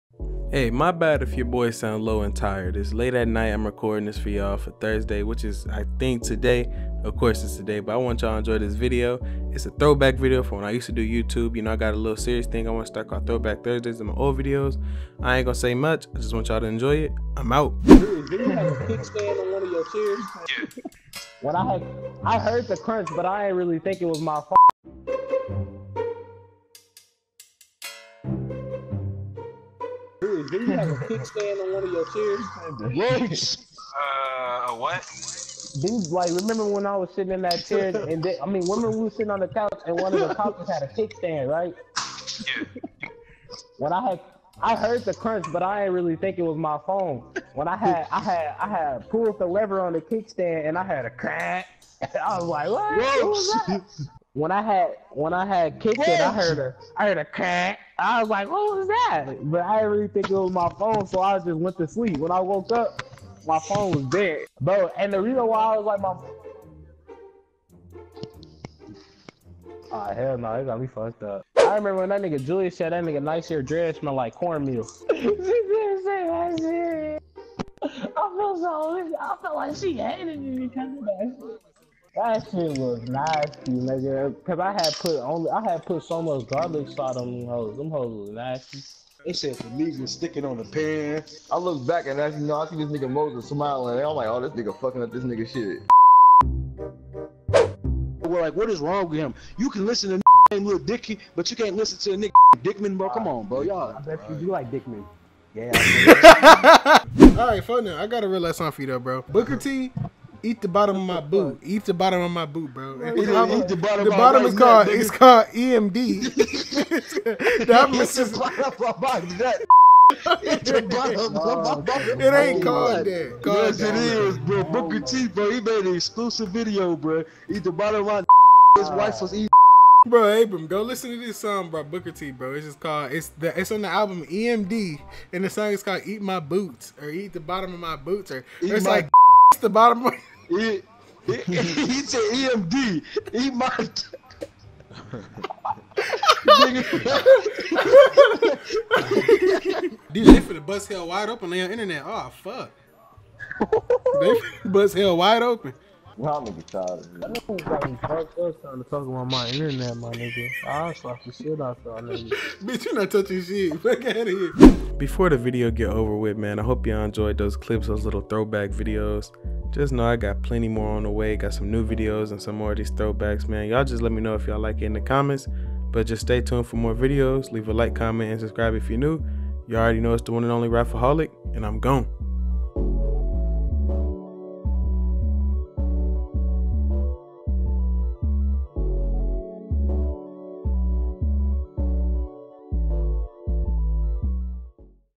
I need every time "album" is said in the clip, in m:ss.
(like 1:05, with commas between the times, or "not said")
1:57, 2:13.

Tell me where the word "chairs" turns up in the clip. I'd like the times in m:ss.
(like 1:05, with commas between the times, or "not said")
0:19, 0:32, 0:37.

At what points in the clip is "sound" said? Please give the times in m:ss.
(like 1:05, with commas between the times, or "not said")
0:01.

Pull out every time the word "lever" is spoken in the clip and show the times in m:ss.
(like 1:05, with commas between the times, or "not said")
0:49.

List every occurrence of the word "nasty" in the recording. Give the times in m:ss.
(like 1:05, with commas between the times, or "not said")
1:23, 1:28.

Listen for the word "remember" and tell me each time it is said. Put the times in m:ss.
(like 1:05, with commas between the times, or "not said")
0:36, 1:11.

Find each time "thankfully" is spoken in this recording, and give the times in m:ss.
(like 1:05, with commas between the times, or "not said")
not said.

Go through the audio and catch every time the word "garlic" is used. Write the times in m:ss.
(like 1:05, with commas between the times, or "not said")
1:26.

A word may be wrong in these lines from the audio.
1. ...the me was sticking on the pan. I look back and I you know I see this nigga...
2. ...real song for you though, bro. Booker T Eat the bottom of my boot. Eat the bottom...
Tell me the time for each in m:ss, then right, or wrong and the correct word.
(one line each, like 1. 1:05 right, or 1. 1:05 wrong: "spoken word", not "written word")
1. 1:29 right
2. 1:48 right.